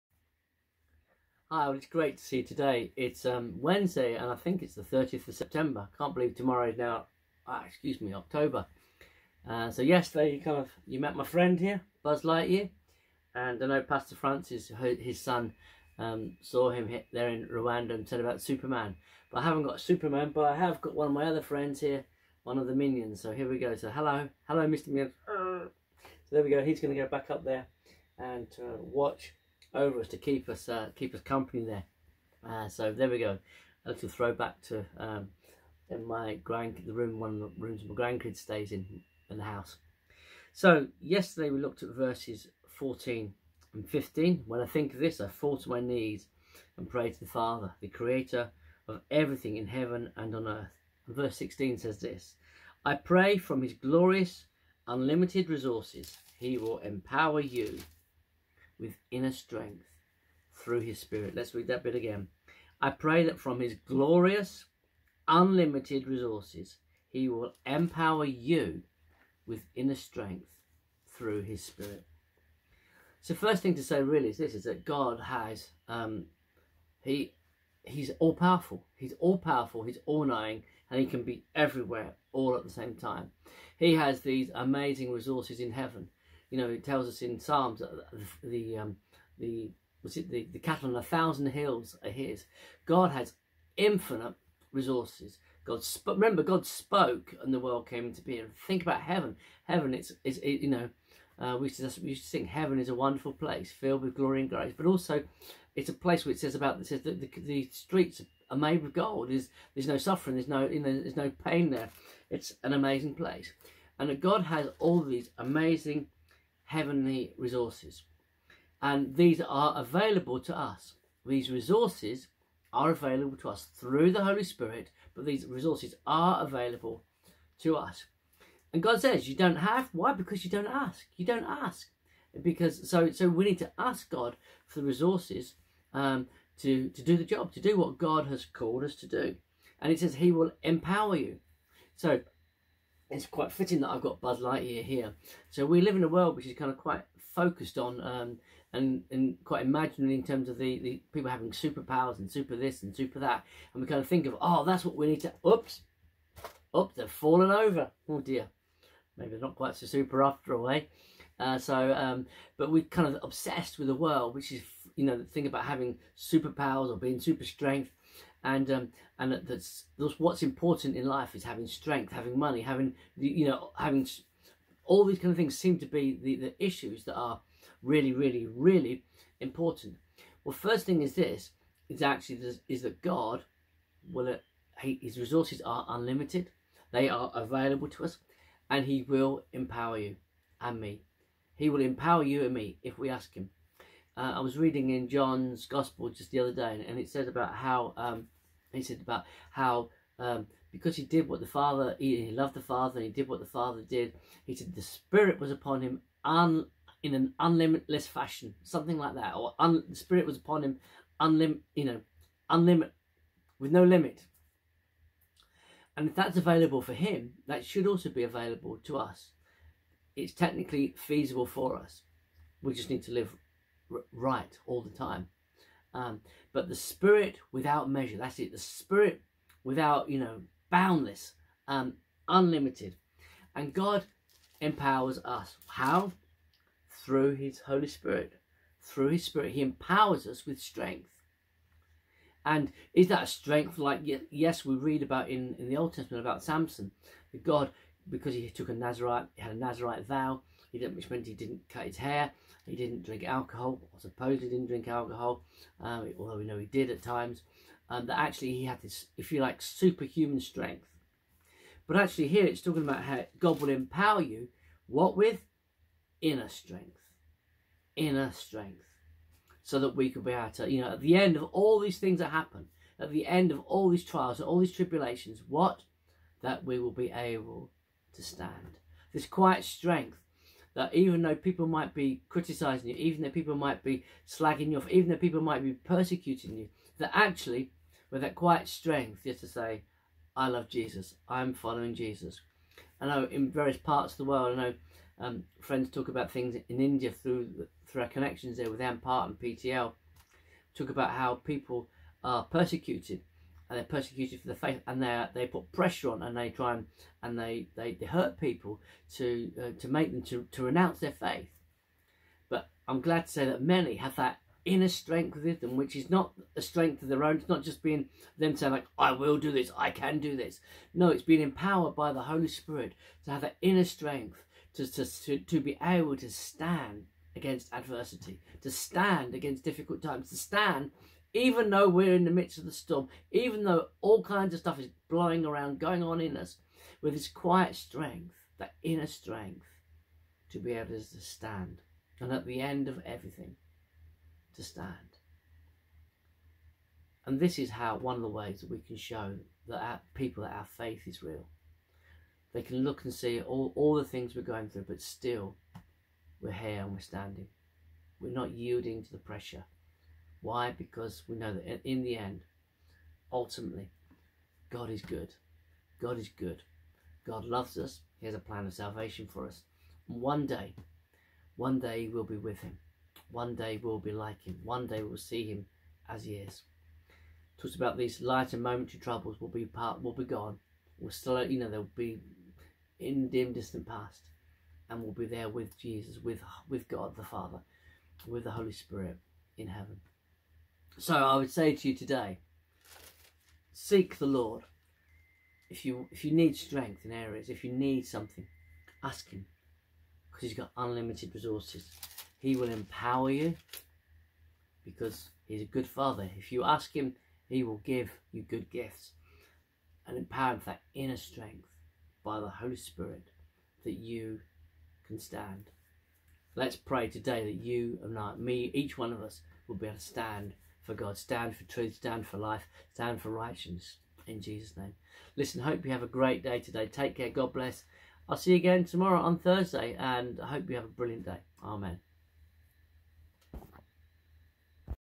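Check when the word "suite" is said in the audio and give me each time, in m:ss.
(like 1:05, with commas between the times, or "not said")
not said.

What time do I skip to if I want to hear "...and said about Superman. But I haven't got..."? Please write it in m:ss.
0:17.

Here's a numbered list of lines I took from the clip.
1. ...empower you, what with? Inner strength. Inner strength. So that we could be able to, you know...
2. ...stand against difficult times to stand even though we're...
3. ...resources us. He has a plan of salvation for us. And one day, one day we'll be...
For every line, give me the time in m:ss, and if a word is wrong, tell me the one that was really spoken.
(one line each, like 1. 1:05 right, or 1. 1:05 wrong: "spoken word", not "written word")
1. 4:23 right
2. 5:28 right
3. 6:07 wrong: "loves", not "resources".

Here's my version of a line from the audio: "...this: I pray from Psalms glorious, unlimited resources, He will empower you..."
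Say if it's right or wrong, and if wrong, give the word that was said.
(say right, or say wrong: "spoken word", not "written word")
wrong: "His", not "Psalms".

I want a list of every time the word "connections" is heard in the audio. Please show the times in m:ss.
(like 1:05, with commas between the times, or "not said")
4:58.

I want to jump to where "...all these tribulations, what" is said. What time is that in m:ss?
4:34.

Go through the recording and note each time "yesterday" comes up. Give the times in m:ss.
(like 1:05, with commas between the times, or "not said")
0:09, 0:41.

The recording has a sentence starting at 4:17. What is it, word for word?
Um, that actually he had this, if you like, superhuman strength.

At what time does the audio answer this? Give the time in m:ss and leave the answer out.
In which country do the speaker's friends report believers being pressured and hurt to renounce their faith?
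4:56.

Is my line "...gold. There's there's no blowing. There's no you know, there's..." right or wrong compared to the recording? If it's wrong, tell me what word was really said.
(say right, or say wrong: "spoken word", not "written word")
wrong: "suffering", not "blowing".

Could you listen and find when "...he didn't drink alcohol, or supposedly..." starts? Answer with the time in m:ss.
4:12.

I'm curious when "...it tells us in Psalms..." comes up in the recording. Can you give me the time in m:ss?
1:26.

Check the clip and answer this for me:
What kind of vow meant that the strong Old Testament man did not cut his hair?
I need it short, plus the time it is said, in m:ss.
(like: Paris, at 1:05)
A Nazarite vow, at 4:09.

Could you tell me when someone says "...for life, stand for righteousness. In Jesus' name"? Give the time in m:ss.
7:02.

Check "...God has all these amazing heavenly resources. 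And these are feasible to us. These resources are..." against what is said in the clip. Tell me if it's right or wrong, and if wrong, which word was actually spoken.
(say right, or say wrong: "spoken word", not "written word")
wrong: "available", not "feasible".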